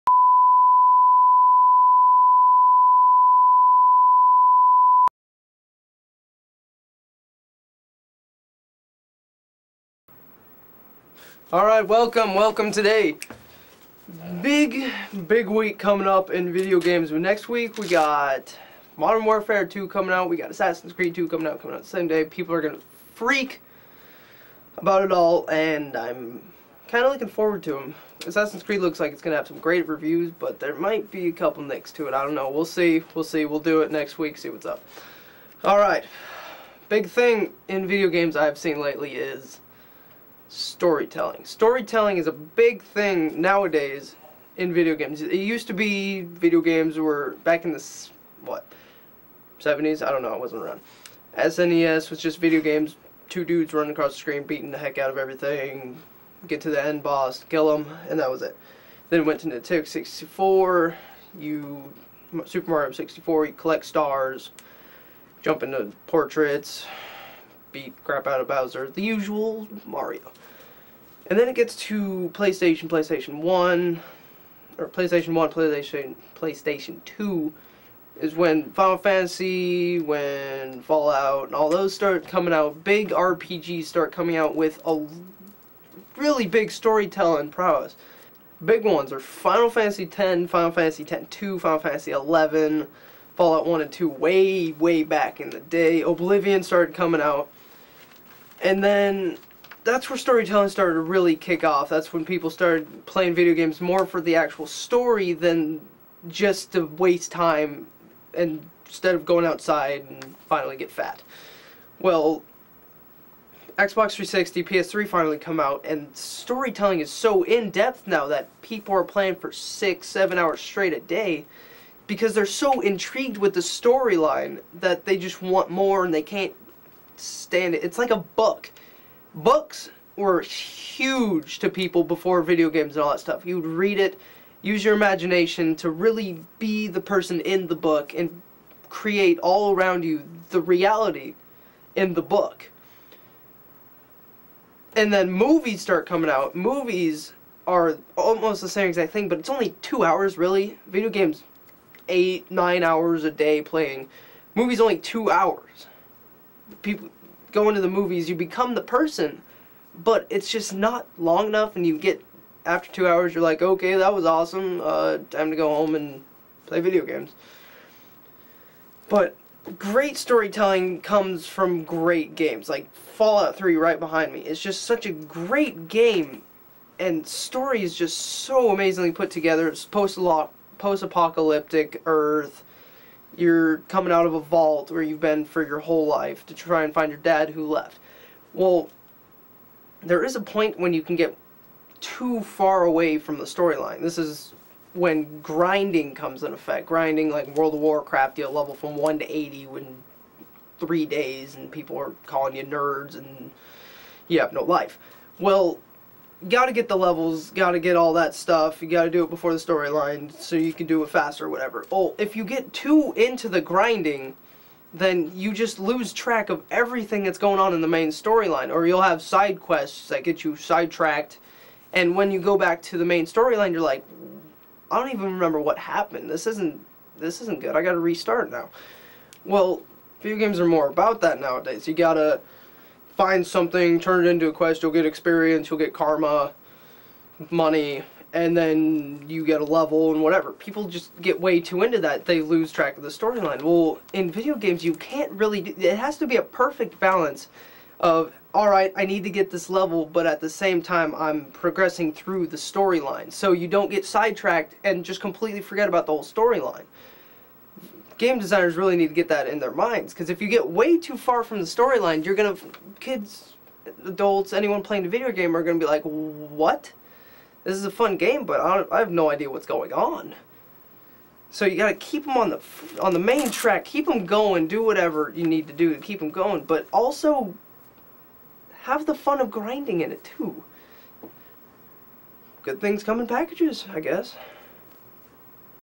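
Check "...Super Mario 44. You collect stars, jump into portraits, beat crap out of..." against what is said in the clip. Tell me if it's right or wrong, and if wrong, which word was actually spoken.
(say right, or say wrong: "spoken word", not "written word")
wrong: "64", not "44".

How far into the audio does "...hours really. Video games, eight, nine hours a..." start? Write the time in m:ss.
2:30.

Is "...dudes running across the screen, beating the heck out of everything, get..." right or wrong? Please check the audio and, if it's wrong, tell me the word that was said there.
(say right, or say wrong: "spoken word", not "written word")
right.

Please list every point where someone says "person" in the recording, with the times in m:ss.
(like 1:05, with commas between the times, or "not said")
2:17, 2:38.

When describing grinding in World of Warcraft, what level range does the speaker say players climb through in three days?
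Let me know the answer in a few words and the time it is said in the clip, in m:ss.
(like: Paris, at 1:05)
1 to 80, at 3:18.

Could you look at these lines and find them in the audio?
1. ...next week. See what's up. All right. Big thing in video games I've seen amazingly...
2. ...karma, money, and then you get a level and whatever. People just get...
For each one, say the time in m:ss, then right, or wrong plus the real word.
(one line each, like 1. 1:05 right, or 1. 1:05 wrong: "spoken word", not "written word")
1. 0:33 wrong: "lately", not "amazingly"
2. 3:55 right.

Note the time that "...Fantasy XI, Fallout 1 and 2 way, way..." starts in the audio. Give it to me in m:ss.
1:31.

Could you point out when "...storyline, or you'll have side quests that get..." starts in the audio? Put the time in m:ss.
3:38.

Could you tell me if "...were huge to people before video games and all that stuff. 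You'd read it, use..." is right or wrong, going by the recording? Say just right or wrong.
right.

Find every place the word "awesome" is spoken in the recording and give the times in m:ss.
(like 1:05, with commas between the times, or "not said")
2:44.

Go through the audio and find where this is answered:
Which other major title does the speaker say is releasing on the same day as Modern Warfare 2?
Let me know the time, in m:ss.
0:20.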